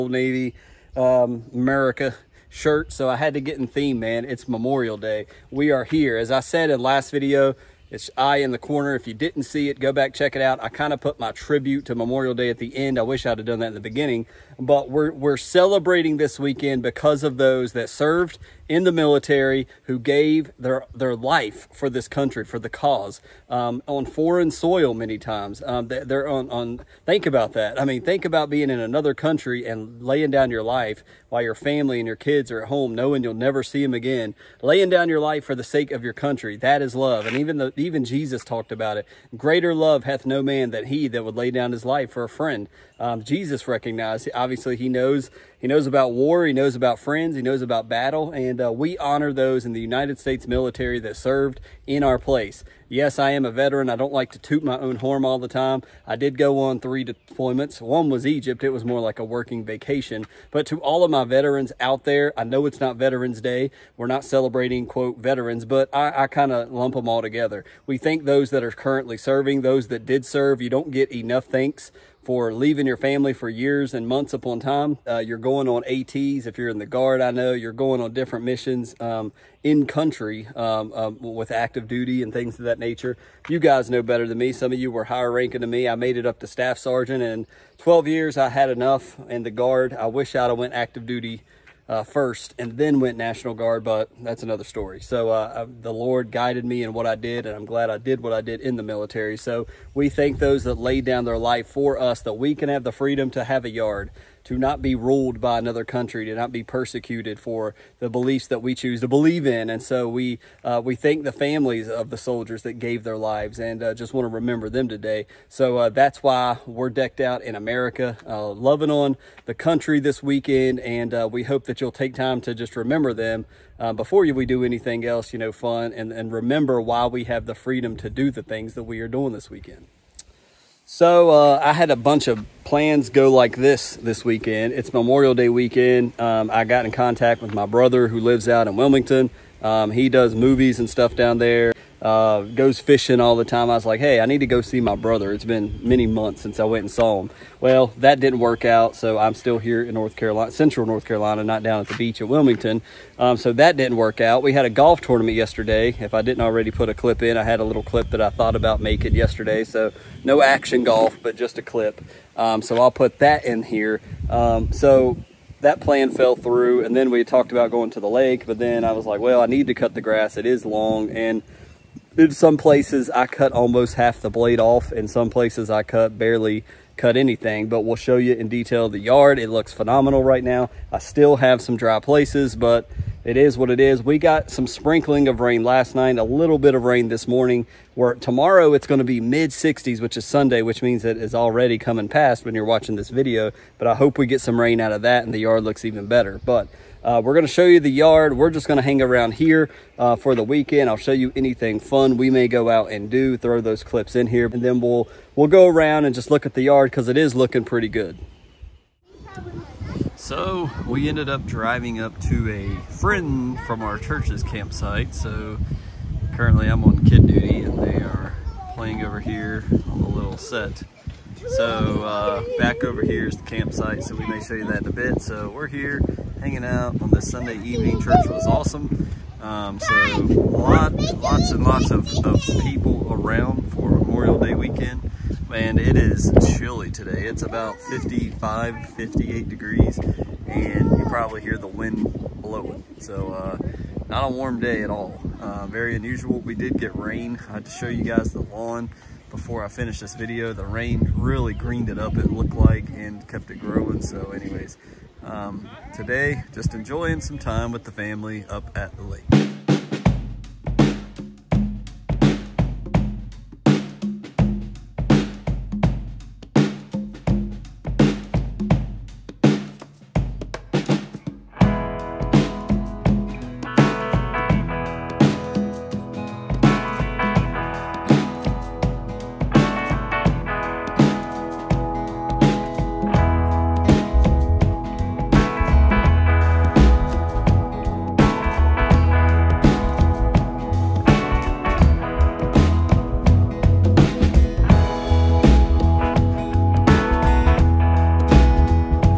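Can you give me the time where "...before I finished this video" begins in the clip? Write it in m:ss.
4:09.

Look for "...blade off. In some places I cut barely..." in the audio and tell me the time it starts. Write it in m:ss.
2:54.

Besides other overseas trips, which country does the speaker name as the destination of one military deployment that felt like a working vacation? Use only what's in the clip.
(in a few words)
Egypt.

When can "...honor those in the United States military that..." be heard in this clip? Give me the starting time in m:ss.
0:48.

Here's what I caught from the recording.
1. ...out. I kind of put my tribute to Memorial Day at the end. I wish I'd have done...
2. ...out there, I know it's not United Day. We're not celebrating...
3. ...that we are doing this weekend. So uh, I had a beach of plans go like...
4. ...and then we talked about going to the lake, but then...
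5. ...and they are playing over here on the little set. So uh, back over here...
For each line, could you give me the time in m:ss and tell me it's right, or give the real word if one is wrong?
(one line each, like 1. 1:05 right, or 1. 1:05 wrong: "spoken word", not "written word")
1. 0:10 right
2. 1:01 wrong: "Veterans", not "United"
3. 2:08 wrong: "bunch", not "beach"
4. 2:46 right
5. 3:37 right.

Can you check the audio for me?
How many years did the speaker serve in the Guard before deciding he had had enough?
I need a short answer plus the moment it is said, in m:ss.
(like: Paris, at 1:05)
12, at 1:27.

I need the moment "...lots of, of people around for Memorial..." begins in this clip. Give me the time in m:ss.
3:51.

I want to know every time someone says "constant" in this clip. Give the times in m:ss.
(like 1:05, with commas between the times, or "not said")
not said.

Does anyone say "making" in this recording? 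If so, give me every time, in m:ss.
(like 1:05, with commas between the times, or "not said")
2:38.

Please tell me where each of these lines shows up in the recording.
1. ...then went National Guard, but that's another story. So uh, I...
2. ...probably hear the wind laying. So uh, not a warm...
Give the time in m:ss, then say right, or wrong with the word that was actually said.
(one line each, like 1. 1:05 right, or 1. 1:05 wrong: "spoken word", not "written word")
1. 1:32 right
2. 4:01 wrong: "blowing", not "laying".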